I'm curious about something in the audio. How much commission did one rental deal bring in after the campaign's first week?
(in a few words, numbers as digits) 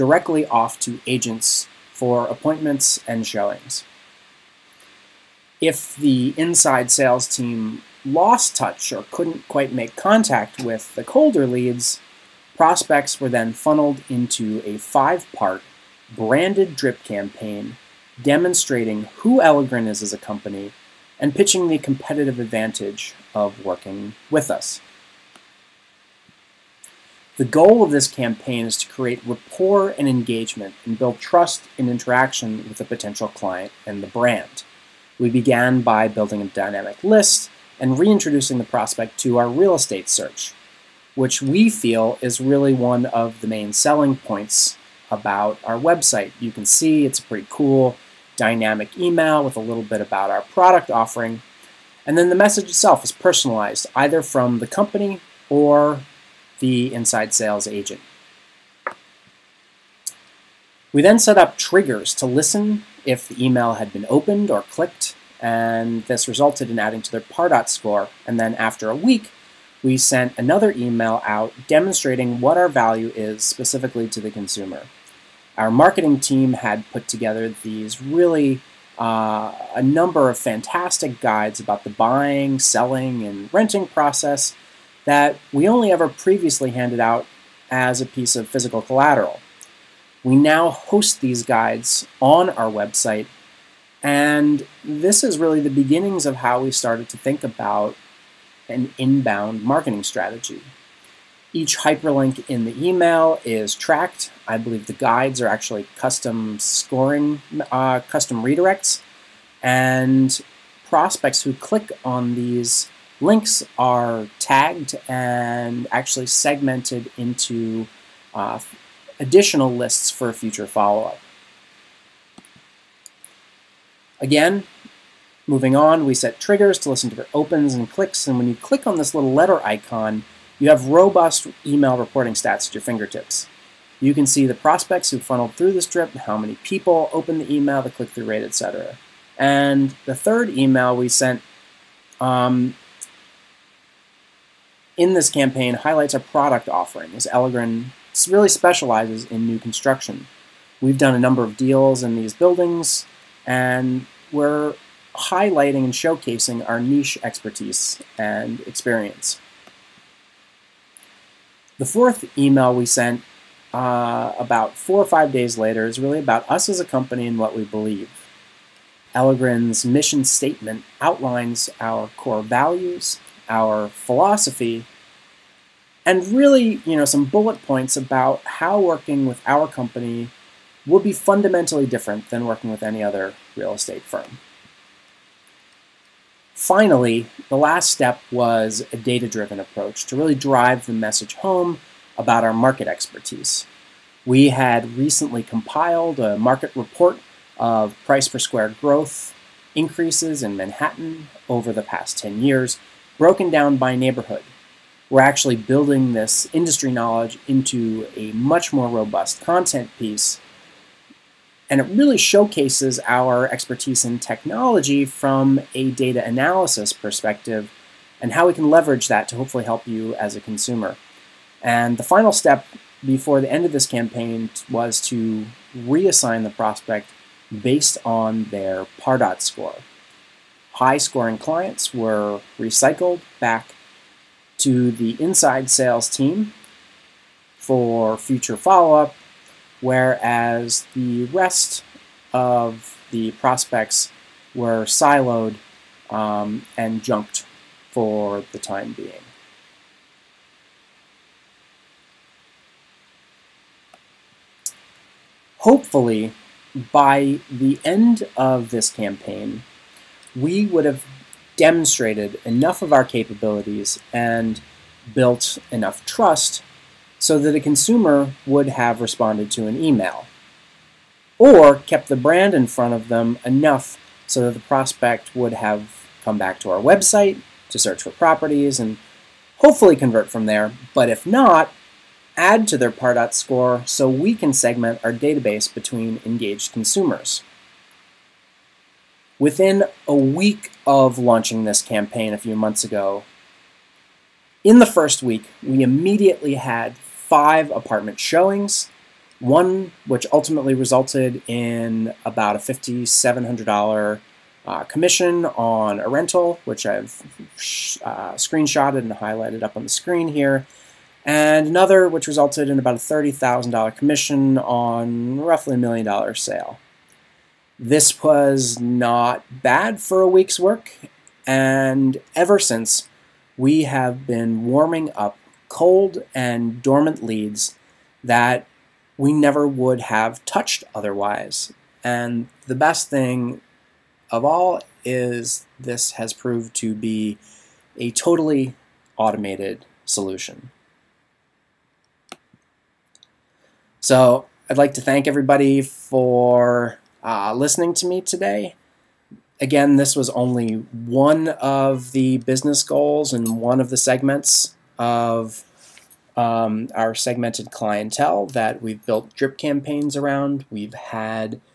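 $5,700.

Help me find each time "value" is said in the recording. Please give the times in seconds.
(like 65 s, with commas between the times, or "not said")
72 s, 172 s.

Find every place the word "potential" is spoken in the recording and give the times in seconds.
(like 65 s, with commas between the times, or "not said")
32 s.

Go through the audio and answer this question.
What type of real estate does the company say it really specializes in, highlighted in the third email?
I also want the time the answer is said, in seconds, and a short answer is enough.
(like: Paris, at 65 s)
New construction, at 149 s.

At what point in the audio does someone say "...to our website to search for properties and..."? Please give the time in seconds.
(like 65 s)
276 s.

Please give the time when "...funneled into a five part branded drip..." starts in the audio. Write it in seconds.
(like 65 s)
13 s.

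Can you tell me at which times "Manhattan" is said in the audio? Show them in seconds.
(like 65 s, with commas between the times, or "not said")
200 s.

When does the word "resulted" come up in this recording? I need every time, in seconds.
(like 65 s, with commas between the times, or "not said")
66 s, 300 s, 312 s.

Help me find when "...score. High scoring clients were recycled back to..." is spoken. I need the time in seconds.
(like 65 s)
229 s.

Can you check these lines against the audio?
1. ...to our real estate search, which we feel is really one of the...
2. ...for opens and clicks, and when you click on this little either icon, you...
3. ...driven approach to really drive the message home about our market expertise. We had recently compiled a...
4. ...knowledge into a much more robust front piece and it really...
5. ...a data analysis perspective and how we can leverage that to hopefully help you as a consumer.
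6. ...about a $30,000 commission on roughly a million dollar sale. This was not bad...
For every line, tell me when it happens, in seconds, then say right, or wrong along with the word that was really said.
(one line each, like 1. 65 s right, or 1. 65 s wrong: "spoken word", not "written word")
1. 39 s right
2. 127 s wrong: "letter", not "either"
3. 189 s right
4. 206 s wrong: "content", not "front"
5. 215 s right
6. 312 s right.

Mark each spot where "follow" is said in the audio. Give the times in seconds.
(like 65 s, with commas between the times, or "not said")
120 s, 238 s.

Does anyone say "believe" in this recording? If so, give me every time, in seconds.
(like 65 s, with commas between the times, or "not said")
104 s, 167 s.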